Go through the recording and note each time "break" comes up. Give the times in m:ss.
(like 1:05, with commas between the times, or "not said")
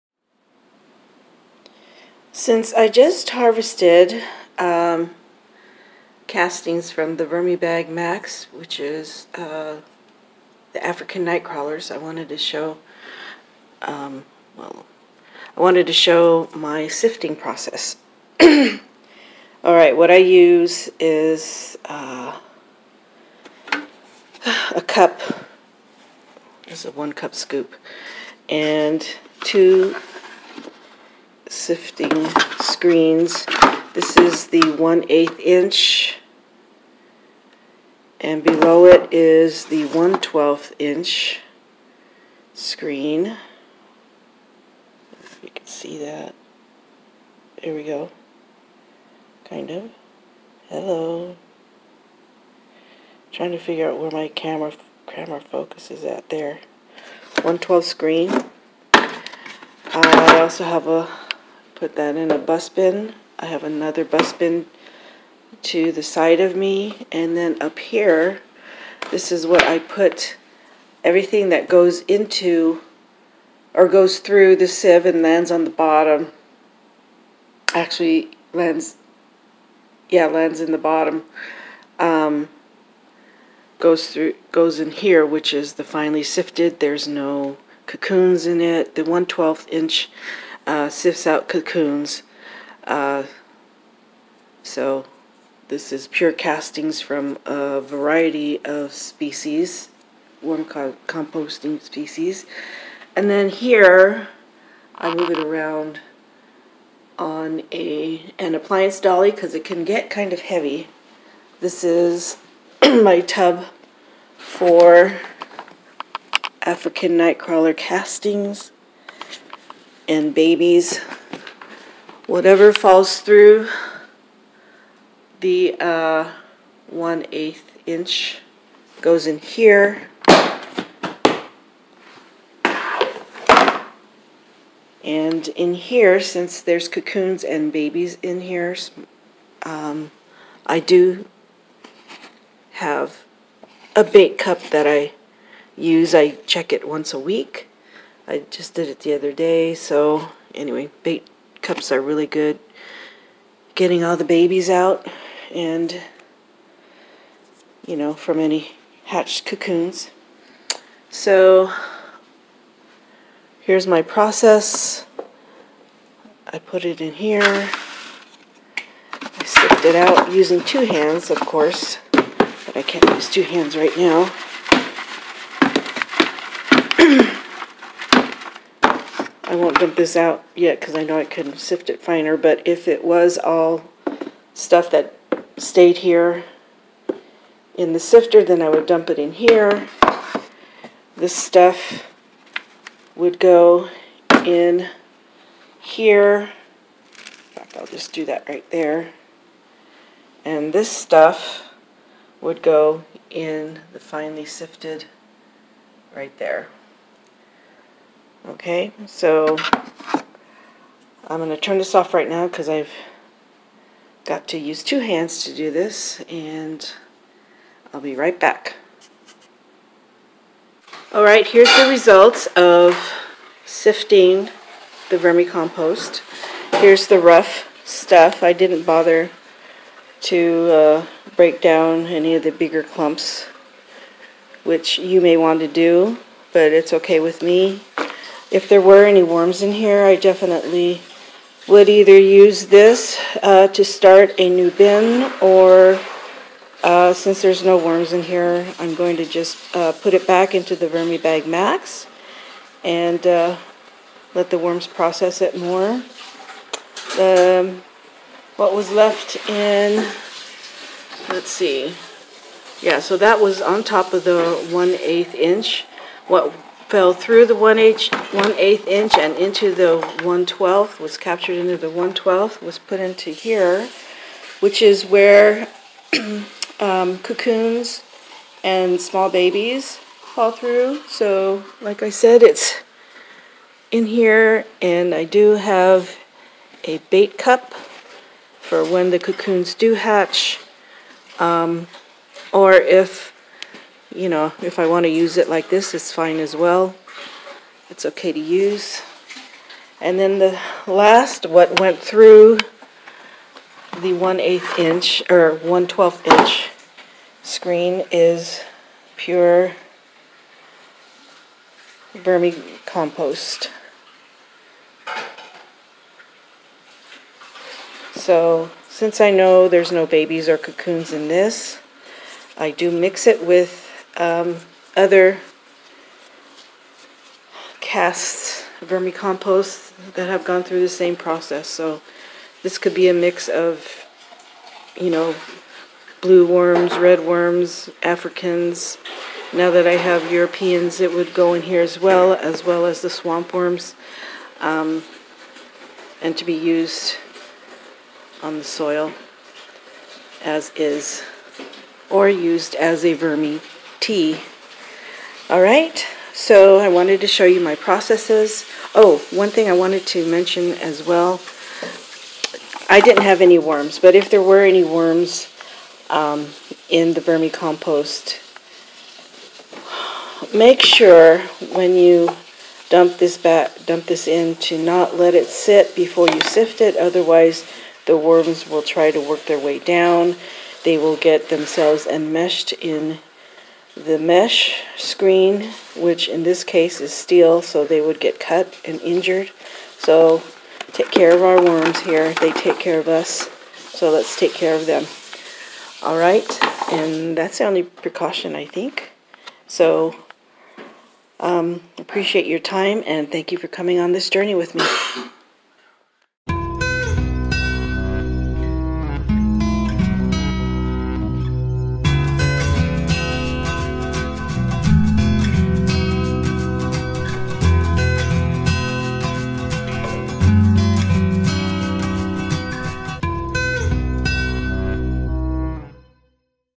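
3:51.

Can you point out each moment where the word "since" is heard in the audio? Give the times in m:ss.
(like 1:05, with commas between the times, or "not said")
0:02, 2:16, 4:07, 5:18.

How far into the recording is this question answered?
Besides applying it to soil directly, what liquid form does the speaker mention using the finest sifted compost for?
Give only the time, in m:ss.
5:53.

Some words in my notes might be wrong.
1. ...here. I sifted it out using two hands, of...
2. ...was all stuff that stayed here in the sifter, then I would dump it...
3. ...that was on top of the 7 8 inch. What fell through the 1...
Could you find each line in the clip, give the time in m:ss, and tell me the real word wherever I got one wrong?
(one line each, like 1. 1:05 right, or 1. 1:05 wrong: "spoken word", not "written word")
1. 2:47 right
2. 3:03 right
3. 4:23 wrong: "1", not "7".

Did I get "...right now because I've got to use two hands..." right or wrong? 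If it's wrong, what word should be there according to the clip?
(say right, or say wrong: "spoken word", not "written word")
right.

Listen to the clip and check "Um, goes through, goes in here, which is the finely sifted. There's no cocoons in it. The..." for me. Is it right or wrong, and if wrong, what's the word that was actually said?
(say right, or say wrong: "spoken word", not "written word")
right.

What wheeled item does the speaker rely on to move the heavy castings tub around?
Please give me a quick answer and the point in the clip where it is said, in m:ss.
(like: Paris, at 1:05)
Appliance dolly, at 1:48.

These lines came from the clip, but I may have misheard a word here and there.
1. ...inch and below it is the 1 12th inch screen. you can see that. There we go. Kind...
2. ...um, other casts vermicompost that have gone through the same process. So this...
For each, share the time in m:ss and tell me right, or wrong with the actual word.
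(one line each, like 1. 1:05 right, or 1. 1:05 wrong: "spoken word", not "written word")
1. 0:35 right
2. 5:24 right.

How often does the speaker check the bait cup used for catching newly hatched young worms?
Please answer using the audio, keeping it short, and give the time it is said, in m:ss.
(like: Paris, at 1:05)
Once a week, at 2:26.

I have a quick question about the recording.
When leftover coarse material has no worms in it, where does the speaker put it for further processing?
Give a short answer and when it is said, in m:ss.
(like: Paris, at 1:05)
Back into the Vermibag Max, at 4:10.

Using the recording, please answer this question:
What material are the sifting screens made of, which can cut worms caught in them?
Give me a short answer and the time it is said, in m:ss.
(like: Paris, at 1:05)
Steel, at 6:27.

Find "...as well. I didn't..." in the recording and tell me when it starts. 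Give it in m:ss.
6:00.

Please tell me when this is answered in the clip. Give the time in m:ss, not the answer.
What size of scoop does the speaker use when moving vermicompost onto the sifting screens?
0:26.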